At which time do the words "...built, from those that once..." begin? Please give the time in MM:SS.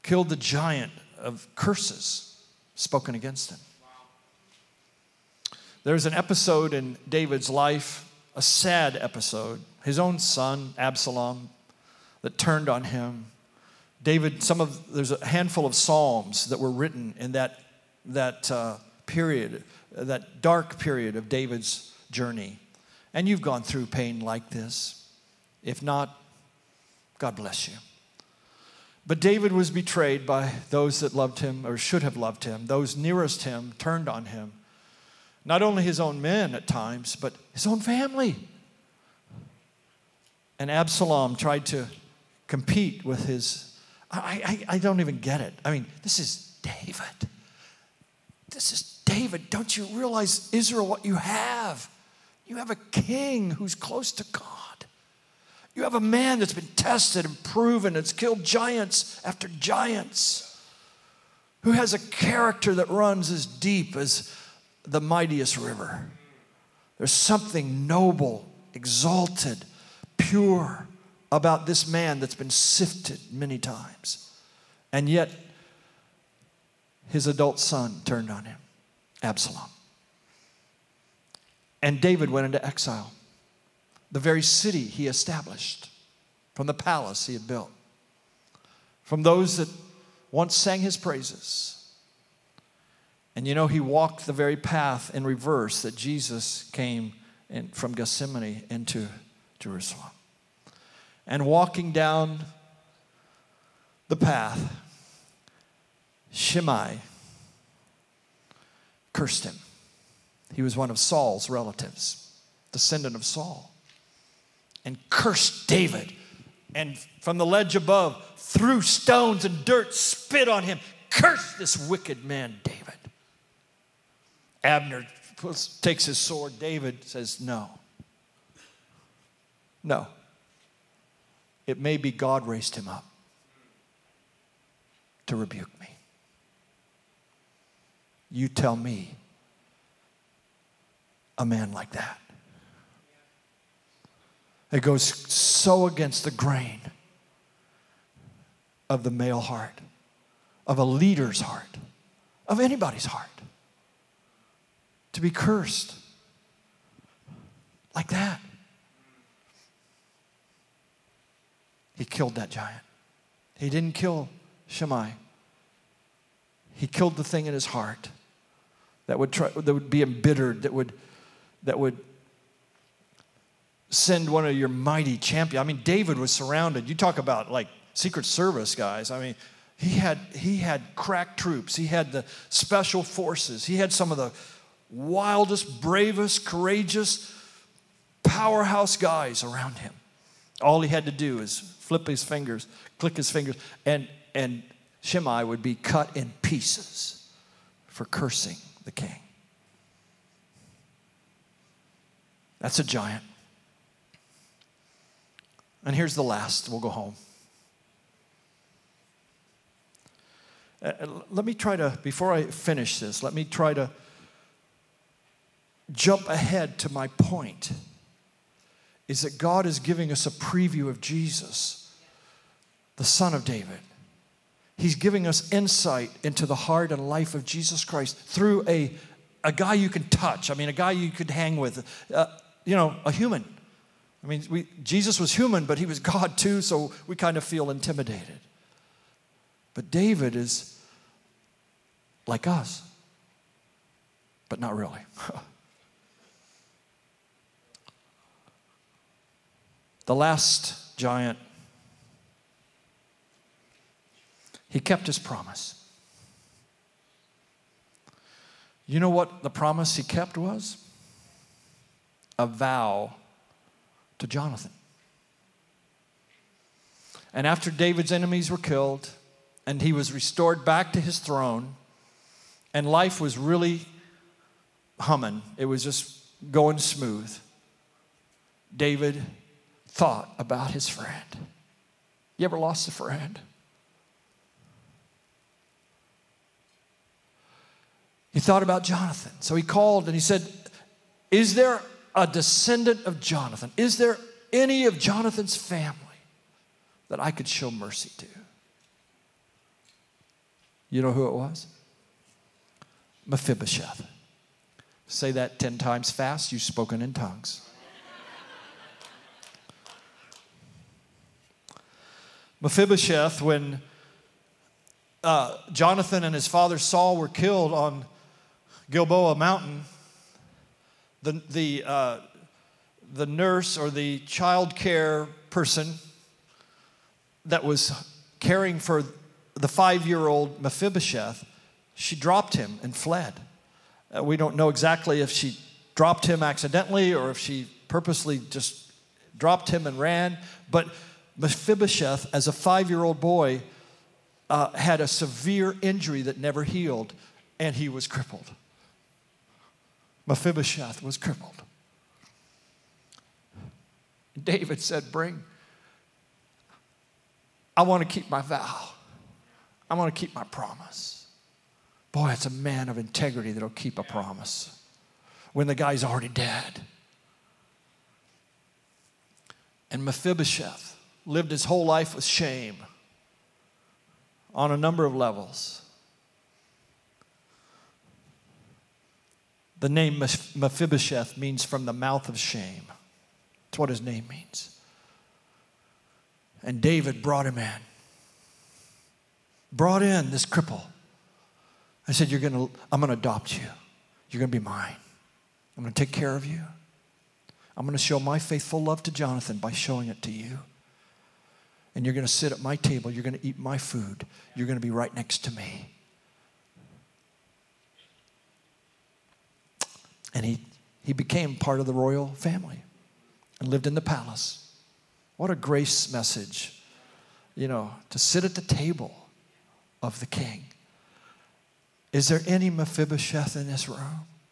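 01:27.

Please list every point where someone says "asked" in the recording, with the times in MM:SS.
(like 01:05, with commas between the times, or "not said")
not said.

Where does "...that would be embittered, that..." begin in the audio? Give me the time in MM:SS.
02:49.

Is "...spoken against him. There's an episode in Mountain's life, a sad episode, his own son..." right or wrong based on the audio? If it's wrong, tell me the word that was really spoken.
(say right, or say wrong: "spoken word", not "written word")
wrong: "David", not "Mountain".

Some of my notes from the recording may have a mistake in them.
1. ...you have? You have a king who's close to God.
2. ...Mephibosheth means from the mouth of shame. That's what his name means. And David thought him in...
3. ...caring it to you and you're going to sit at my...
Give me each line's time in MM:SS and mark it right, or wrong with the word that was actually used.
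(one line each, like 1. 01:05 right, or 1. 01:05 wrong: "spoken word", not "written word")
1. 00:51 right
2. 06:20 wrong: "brought", not "thought"
3. 06:39 wrong: "showing", not "caring".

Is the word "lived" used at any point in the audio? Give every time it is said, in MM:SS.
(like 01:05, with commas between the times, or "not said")
06:11, 06:53.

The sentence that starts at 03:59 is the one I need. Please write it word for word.
But David is like us, but not really.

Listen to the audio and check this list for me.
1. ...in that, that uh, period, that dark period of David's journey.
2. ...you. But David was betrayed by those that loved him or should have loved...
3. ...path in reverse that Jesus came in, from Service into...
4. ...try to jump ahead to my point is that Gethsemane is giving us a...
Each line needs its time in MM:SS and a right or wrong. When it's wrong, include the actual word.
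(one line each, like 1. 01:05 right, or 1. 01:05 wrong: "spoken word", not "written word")
1. 00:17 right
2. 00:27 right
3. 01:34 wrong: "Gethsemane", not "Service"
4. 03:33 wrong: "God", not "Gethsemane".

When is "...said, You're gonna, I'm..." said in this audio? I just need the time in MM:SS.
06:32.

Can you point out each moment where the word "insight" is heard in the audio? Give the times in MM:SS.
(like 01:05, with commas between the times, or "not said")
03:45.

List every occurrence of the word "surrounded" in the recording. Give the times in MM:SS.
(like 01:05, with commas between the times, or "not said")
02:56.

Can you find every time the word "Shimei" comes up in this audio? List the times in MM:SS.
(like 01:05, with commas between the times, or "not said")
01:46, 02:44, 03:15.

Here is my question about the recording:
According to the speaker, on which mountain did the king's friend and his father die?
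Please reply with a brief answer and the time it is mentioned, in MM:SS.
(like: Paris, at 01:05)
Gilboa Mountain, at 05:18.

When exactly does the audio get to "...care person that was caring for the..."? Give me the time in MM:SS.
05:24.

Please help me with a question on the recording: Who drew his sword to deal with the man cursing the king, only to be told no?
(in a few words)
Abner.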